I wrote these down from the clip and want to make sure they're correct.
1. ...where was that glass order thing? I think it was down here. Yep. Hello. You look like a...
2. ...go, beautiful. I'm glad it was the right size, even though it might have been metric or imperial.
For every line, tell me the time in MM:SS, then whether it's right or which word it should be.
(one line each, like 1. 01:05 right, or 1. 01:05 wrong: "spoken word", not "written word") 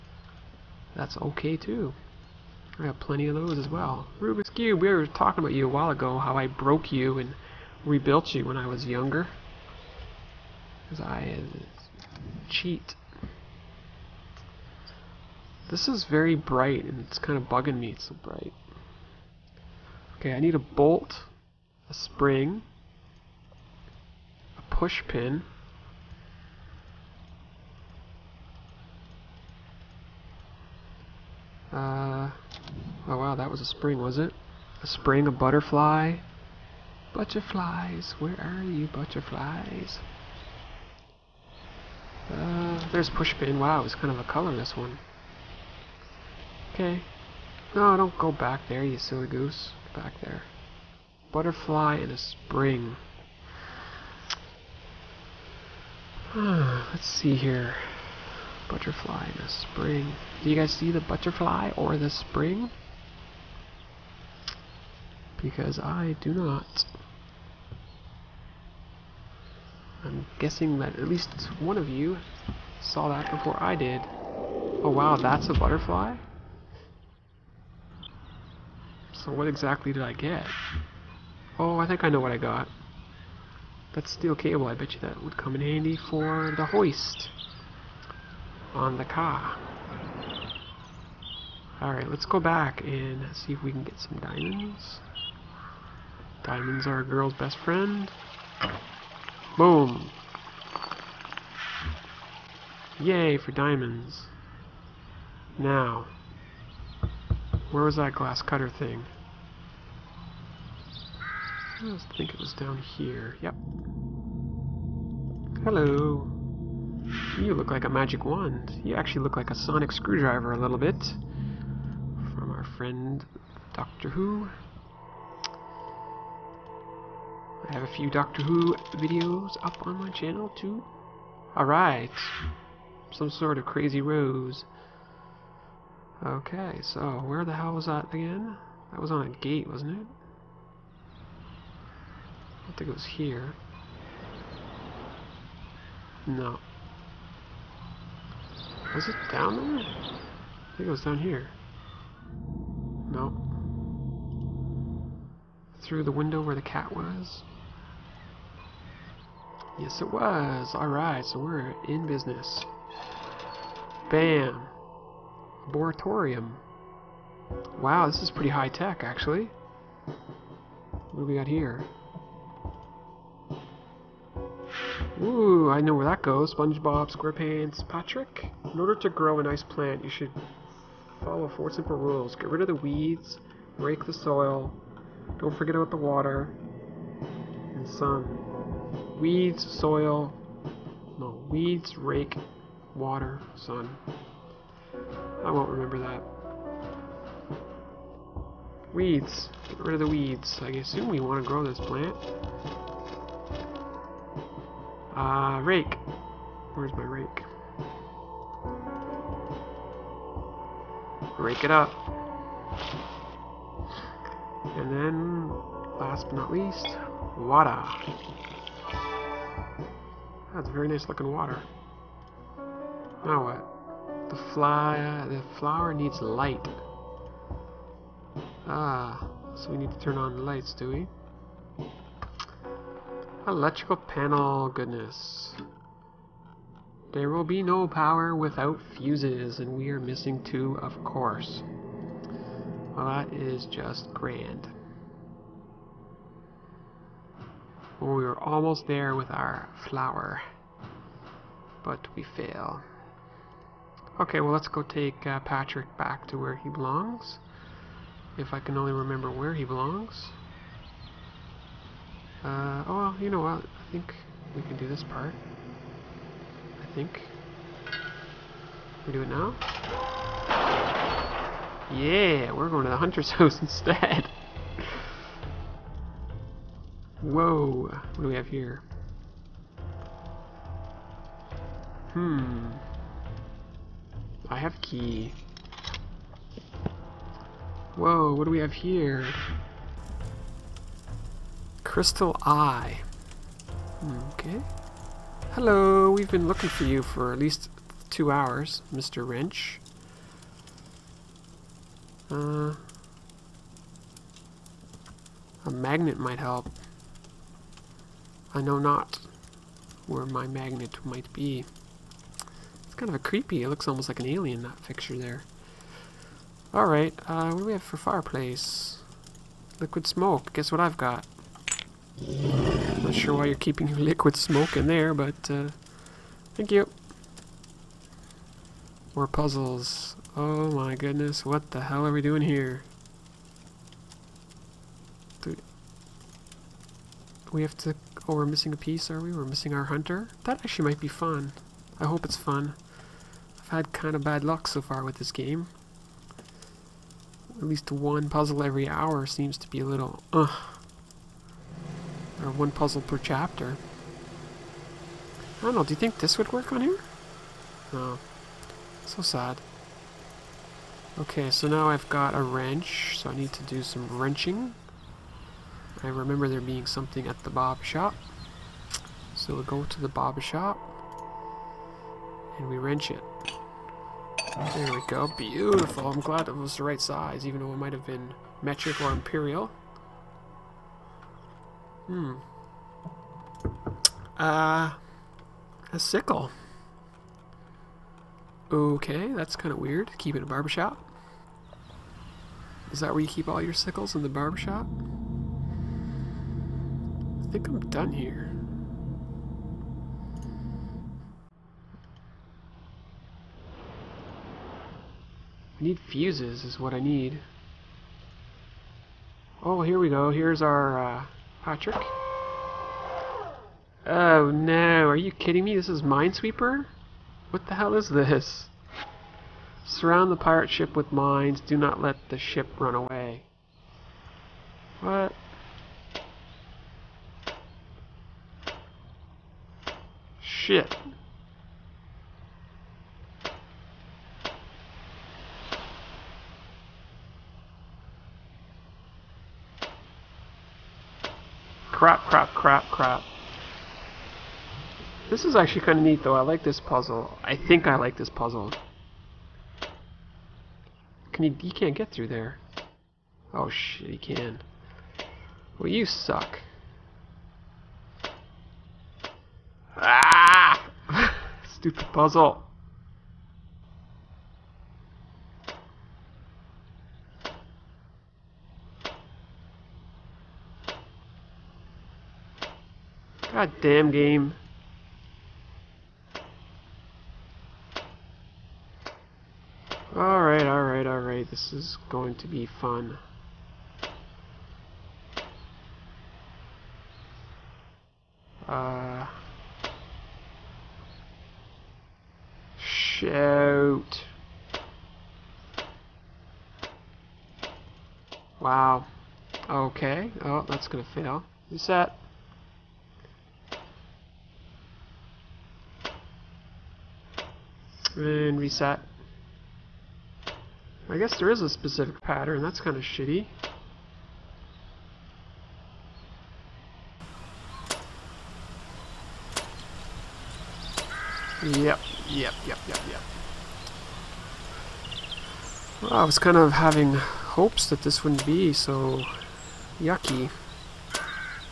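1. 01:47 wrong: "cutter", not "order"
2. 06:15 right.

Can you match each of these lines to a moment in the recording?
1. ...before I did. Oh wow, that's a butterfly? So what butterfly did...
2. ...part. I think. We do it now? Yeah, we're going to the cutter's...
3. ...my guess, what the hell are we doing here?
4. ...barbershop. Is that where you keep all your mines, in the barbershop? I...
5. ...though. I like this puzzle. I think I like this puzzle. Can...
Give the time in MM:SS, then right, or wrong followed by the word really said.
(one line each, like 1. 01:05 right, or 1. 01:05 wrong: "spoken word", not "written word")
1. 01:13 wrong: "exactly", not "butterfly"
2. 04:25 wrong: "hunter", not "cutter"
3. 05:30 wrong: "goodness", not "guess"
4. 06:30 wrong: "sickles", not "mines"
5. 07:26 right.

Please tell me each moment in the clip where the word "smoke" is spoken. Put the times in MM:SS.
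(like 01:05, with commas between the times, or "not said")
05:20, 05:24.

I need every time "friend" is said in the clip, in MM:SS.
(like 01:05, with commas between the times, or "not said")
01:37, 02:02.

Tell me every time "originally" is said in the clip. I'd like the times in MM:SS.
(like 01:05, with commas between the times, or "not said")
not said.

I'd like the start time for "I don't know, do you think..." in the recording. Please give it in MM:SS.
05:55.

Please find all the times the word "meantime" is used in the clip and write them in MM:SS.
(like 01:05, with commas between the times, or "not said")
not said.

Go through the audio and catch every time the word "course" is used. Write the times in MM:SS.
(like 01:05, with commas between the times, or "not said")
04:01.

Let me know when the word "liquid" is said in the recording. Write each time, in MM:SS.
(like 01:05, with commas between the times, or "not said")
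05:19, 05:23.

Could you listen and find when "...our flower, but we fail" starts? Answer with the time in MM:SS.
04:09.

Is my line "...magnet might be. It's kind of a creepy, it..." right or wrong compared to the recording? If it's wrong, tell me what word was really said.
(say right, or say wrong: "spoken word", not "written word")
right.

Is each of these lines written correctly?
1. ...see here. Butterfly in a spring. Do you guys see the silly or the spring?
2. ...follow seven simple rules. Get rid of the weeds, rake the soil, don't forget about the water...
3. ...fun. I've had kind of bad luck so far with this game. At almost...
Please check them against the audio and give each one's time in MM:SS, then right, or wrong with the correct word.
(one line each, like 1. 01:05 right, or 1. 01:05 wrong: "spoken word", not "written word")
1. 00:57 wrong: "butterfly", not "silly"
2. 03:01 wrong: "four", not "seven"
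3. 05:42 wrong: "least", not "almost".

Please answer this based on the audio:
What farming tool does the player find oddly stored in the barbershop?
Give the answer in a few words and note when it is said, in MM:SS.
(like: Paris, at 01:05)
sickle, at 06:25.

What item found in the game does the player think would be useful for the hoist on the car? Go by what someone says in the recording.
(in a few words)
steel cable.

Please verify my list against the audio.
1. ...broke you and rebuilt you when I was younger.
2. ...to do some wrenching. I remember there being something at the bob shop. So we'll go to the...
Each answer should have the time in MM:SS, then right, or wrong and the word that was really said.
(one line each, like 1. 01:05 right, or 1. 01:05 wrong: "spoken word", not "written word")
1. 00:06 right
2. 06:03 right.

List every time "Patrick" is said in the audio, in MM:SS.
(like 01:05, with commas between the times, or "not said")
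02:57, 04:15, 06:51.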